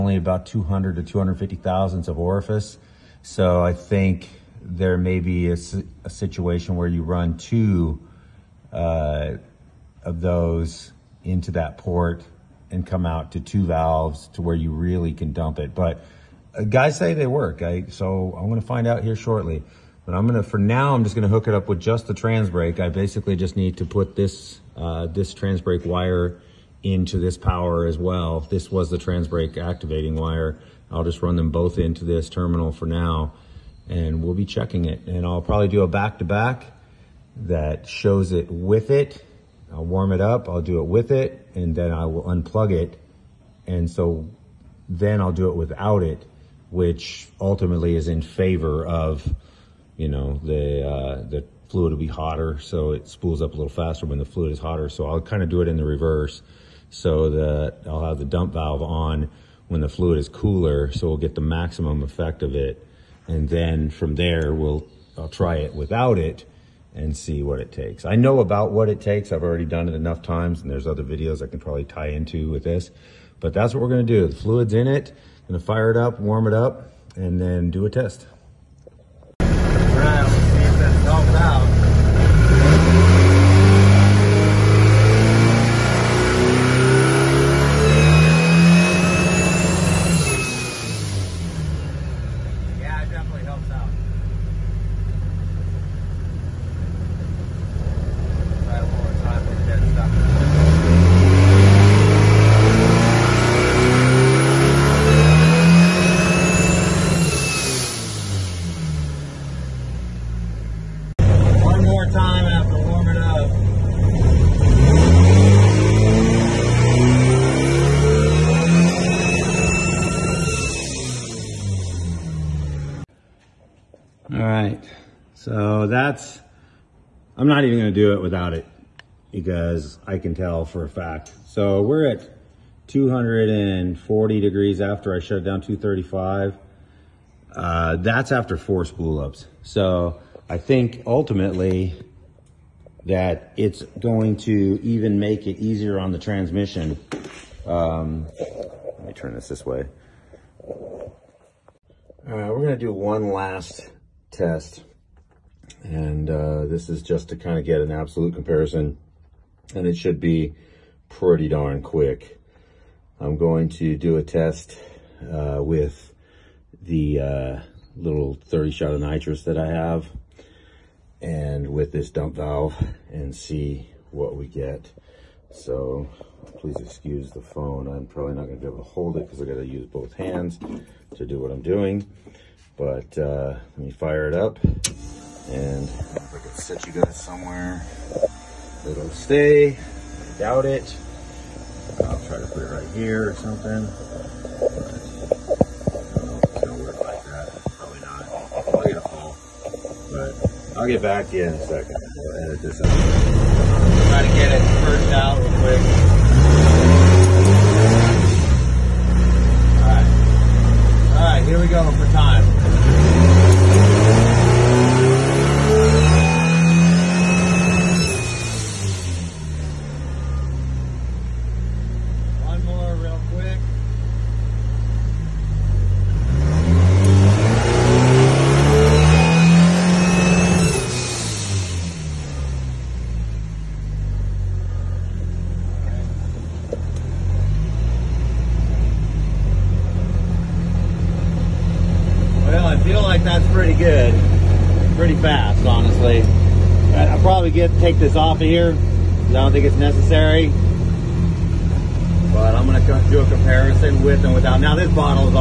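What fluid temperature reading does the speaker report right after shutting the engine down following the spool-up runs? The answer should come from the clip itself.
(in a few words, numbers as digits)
235.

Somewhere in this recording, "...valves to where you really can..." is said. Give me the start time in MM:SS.
00:13.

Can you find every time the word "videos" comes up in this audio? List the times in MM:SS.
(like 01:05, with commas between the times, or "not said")
01:11.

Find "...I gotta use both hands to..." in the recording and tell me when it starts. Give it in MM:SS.
02:59.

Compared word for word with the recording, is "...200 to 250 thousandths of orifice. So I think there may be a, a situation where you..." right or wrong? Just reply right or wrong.
right.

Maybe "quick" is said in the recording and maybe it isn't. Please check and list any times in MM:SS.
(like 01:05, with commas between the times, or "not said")
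02:41, 03:25.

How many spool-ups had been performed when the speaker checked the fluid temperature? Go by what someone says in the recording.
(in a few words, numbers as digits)
4.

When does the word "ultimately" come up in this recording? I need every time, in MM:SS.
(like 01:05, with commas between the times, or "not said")
00:47, 02:21.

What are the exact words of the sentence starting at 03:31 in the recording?
Alright, here we go for time.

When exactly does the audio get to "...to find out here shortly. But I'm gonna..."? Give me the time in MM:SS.
00:18.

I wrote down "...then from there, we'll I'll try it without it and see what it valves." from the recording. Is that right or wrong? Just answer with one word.
wrong.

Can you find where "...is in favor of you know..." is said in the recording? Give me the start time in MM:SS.
00:47.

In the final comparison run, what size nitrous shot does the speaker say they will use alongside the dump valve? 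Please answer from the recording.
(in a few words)
30 shot.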